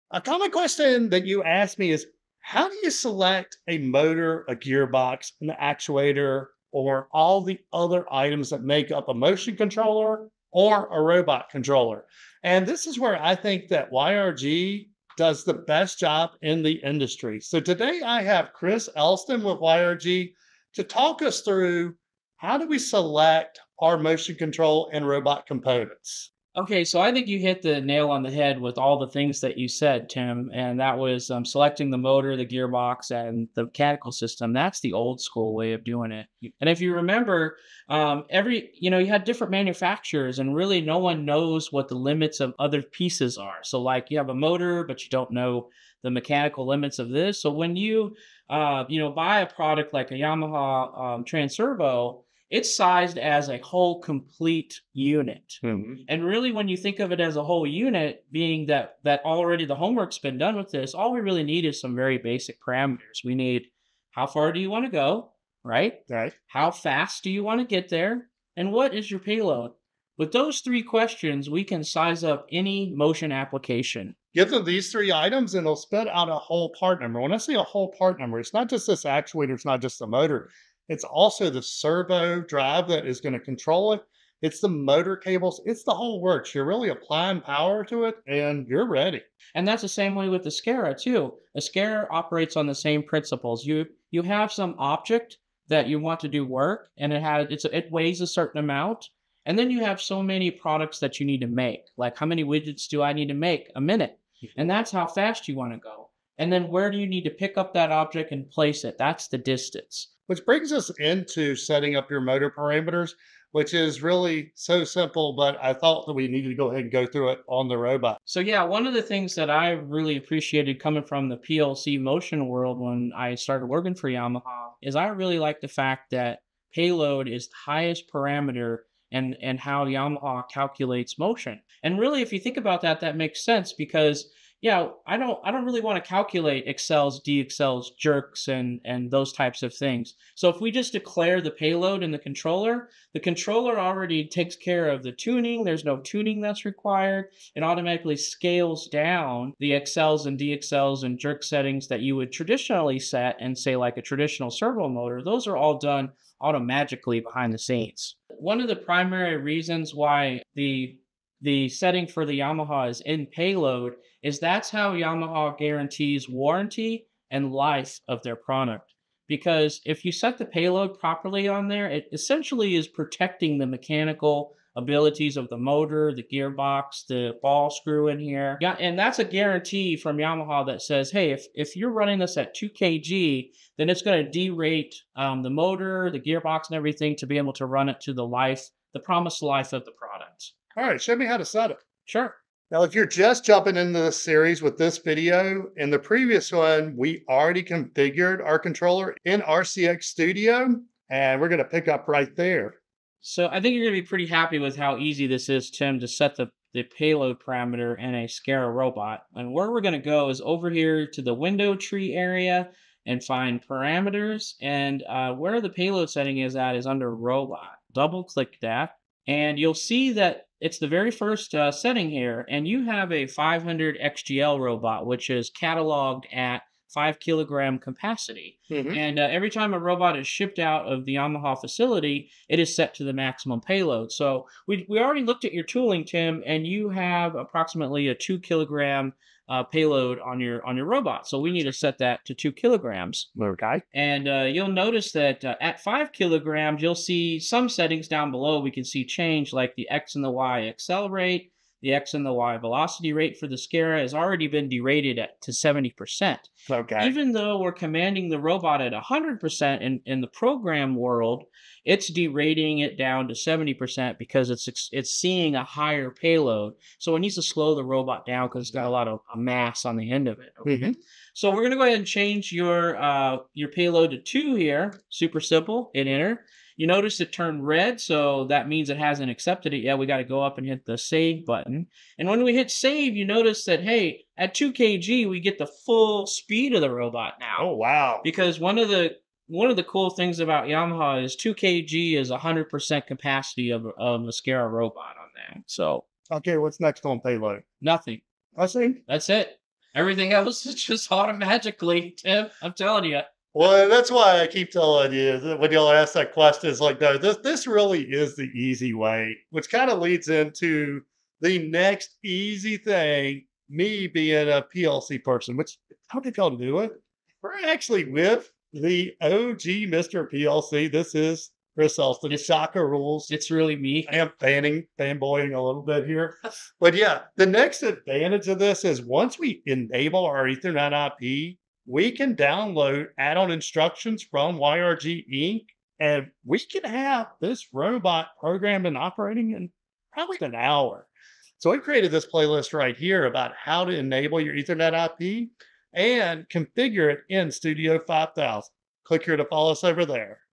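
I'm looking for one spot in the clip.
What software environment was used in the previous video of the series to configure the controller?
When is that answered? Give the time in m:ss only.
3:19.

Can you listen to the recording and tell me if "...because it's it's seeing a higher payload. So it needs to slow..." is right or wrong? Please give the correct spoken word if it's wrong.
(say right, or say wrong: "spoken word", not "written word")
right.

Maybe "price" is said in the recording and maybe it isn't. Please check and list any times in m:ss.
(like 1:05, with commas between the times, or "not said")
not said.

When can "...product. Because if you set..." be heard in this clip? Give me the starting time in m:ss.
2:48.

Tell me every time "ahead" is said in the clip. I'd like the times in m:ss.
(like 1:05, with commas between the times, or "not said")
1:56, 4:31.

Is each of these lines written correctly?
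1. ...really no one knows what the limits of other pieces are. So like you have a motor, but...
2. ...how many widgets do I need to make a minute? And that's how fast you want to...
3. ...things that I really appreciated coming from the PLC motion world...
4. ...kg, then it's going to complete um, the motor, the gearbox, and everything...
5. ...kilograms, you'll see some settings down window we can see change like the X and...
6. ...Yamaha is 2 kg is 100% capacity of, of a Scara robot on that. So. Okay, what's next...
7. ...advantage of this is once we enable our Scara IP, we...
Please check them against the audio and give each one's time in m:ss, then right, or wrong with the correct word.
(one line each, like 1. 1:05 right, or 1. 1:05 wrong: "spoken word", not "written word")
1. 0:40 right
2. 1:42 right
3. 1:59 right
4. 3:02 wrong: "derate", not "complete"
5. 4:06 wrong: "below", not "window"
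6. 4:50 right
7. 5:27 wrong: "Ethernet", not "Scara".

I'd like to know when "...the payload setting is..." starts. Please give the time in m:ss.
3:35.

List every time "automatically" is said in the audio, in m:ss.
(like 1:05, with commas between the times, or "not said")
2:27, 2:36, 5:01.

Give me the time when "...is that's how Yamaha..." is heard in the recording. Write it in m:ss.
2:44.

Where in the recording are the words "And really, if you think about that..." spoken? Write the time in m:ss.
2:11.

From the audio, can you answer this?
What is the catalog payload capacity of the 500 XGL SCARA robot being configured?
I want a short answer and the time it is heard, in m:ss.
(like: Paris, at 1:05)
5 kilograms, at 3:46.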